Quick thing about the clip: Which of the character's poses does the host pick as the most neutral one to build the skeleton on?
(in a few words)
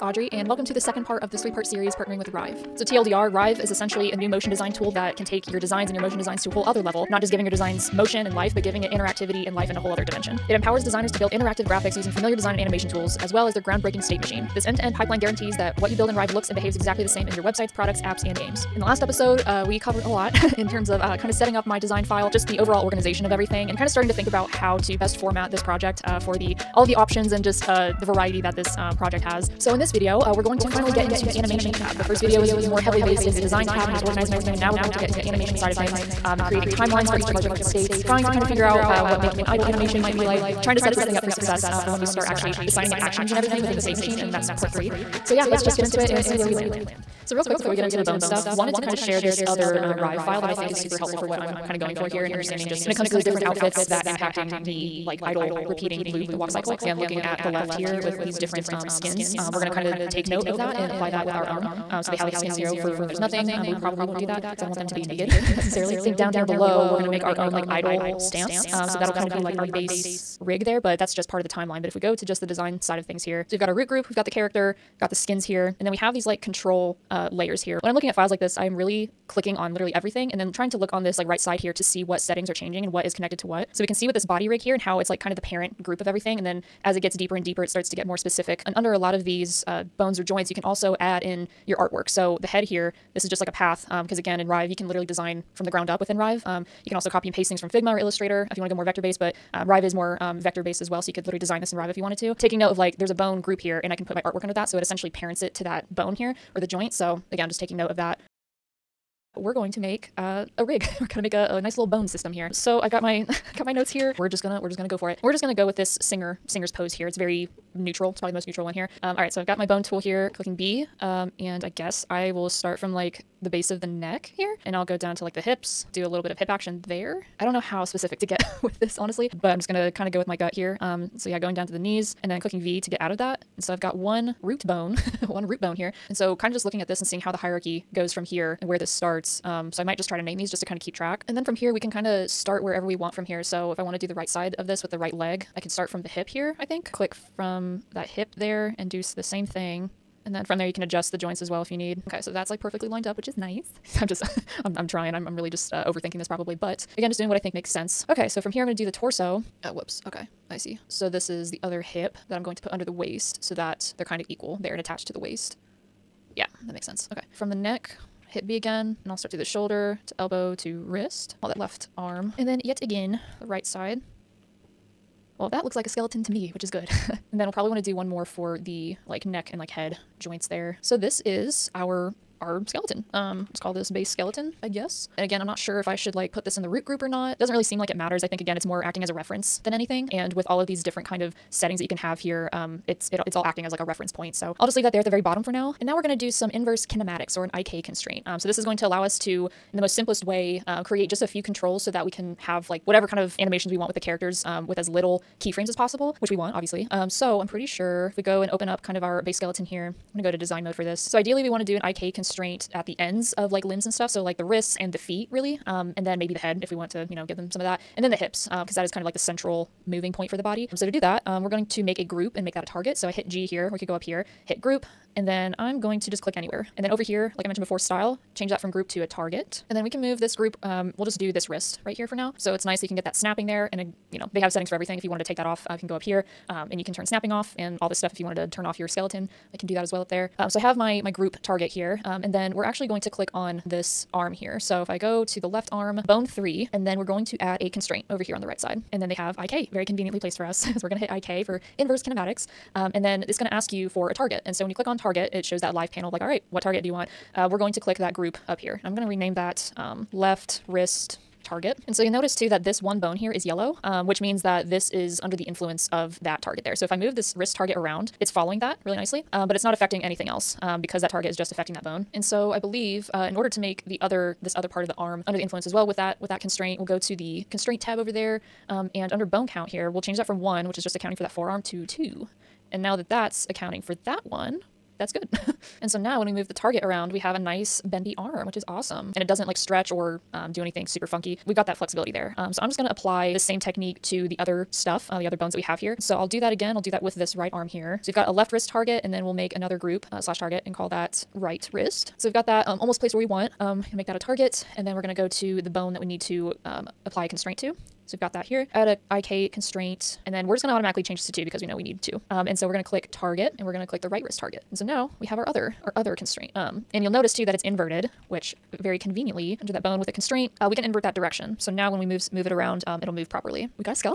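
singer's pose.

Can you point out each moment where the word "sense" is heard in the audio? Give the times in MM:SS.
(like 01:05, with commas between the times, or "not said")
02:37, 02:46.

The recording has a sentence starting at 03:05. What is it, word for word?
And again, I'm not sure if I should like put this in the root group or not.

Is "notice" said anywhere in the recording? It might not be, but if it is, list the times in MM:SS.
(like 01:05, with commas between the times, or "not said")
04:22, 05:17.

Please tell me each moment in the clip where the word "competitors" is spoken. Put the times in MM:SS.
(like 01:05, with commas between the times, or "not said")
not said.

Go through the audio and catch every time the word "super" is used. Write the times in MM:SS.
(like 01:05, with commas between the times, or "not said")
00:50, 04:50.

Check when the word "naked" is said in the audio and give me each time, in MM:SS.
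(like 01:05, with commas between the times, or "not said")
01:05.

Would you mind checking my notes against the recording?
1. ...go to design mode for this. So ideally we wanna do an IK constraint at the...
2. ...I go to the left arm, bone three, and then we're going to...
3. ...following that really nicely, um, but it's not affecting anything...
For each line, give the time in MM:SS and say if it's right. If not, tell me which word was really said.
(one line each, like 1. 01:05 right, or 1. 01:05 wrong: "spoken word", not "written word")
1. 03:30 right
2. 04:04 right
3. 04:28 right.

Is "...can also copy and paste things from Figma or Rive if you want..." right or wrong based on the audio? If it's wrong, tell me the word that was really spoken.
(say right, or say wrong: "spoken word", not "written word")
wrong: "Illustrator", not "Rive".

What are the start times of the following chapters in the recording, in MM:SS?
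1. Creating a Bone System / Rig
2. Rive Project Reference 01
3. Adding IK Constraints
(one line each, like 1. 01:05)
1. 01:47
2. 00:46
3. 03:15.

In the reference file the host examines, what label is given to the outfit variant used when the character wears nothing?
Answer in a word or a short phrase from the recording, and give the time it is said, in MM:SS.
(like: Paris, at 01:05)
skin zero, at 01:02.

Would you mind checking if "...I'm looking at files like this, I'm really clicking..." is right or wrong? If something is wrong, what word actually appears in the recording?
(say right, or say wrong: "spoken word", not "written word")
right.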